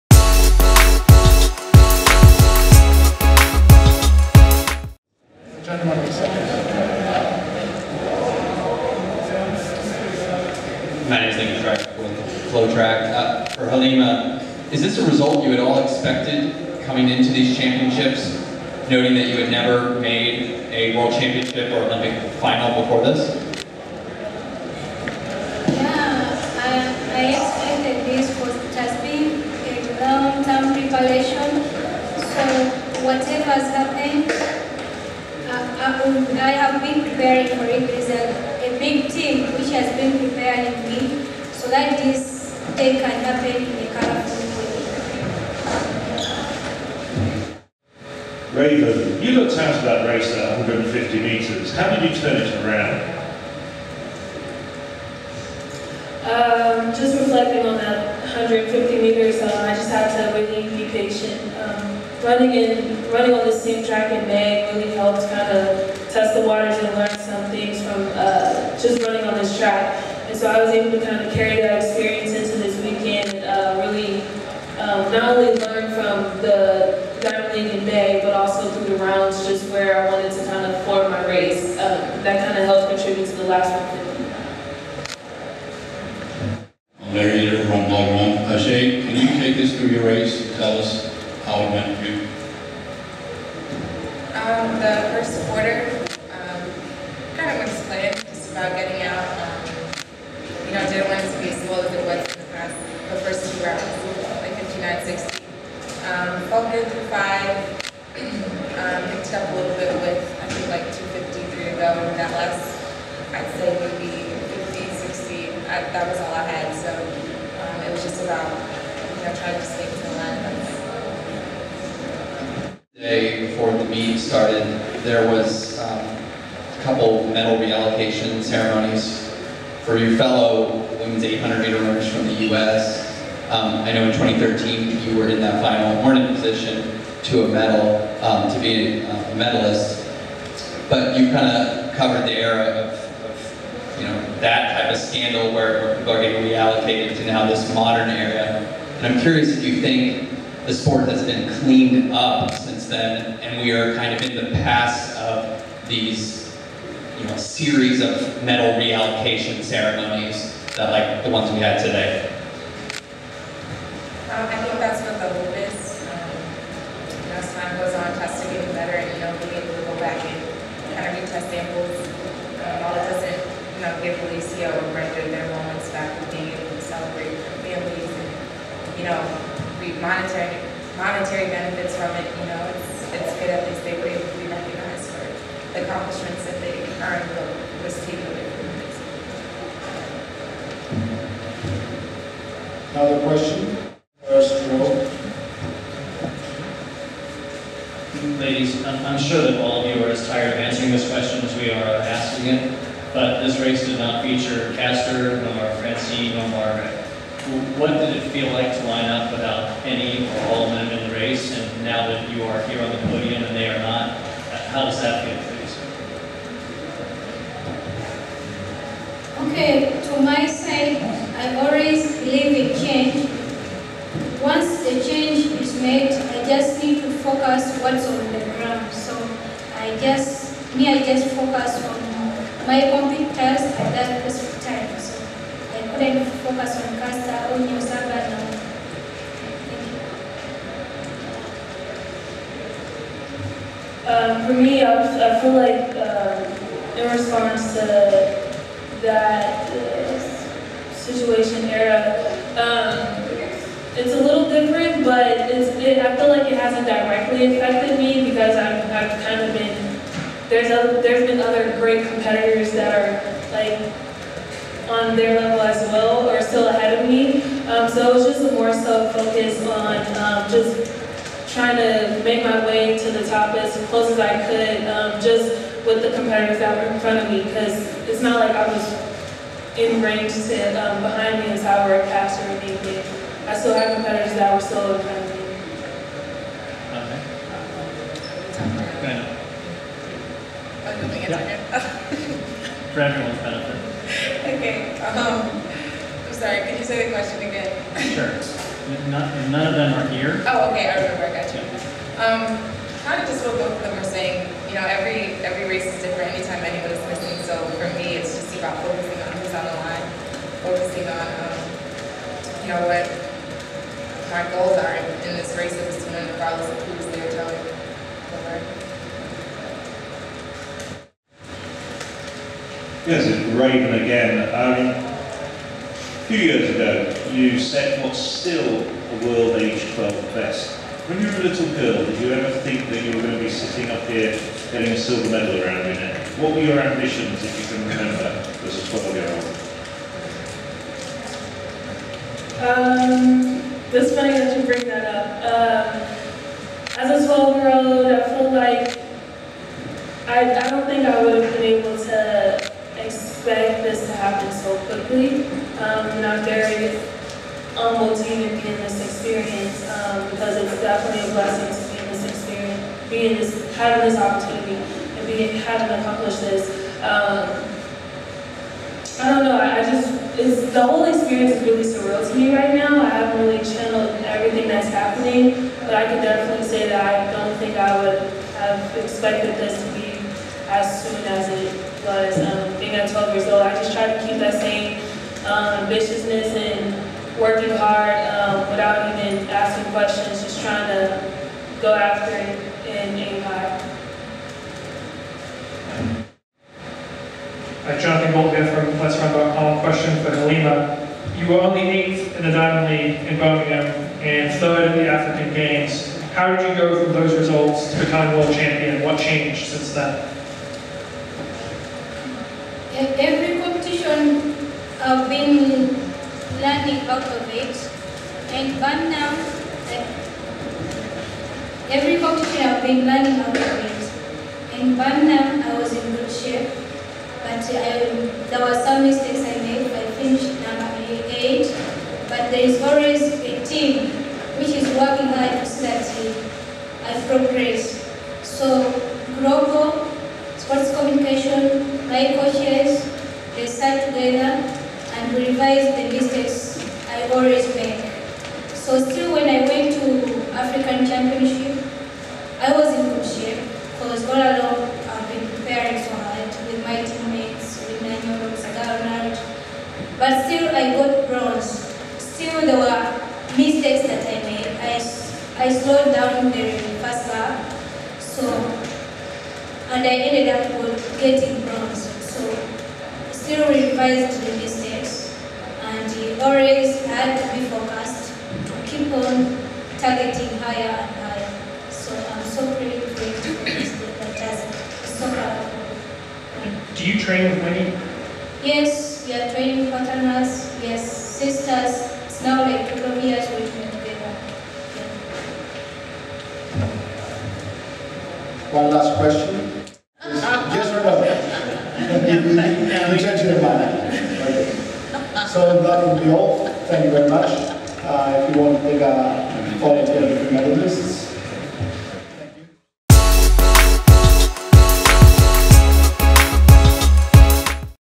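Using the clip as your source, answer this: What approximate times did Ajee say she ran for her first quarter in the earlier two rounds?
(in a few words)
59, 60.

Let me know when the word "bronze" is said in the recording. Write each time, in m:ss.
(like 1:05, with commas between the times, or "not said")
7:41, 7:51.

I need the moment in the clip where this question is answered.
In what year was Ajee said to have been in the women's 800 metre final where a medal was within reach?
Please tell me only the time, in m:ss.
2:14.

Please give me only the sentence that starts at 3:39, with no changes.
Okay, to my side, I always believe in change.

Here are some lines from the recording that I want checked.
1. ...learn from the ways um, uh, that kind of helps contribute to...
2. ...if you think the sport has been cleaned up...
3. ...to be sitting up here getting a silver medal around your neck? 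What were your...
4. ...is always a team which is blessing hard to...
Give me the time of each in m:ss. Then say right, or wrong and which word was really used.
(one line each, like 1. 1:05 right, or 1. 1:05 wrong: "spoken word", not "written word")
1. 1:15 right
2. 2:29 right
3. 5:33 right
4. 7:12 wrong: "working", not "blessing".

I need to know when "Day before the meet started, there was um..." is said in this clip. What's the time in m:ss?
2:02.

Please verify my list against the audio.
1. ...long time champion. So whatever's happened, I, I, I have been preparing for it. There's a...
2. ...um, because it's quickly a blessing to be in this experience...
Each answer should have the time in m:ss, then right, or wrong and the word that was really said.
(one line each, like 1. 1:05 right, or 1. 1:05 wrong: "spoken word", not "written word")
1. 0:30 wrong: "preparation", not "champion"
2. 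5:59 wrong: "definitely", not "quickly".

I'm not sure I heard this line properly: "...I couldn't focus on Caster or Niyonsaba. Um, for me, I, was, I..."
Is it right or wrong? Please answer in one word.
right.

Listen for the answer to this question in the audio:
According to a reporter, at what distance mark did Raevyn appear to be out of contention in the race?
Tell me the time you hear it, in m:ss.
0:50.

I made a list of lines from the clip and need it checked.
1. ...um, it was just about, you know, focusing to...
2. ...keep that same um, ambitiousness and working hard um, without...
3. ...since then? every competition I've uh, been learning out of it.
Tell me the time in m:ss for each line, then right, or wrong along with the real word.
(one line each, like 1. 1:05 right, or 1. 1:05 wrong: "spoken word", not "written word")
1. 1:56 wrong: "trying", not "focusing"
2. 6:24 right
3. 6:49 right.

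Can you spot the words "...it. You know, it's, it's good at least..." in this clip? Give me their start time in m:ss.
3:02.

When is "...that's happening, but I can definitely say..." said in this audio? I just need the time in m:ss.
6:14.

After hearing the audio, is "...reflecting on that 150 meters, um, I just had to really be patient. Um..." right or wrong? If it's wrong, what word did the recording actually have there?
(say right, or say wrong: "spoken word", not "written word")
right.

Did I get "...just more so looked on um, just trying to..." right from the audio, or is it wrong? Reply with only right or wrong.
wrong.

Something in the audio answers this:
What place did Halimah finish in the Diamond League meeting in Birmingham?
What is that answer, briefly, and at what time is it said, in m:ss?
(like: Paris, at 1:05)
Eighth, at 6:41.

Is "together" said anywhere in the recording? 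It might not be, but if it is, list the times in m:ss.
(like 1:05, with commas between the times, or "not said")
7:24, 8:13.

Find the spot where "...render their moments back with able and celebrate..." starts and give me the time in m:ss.
2:54.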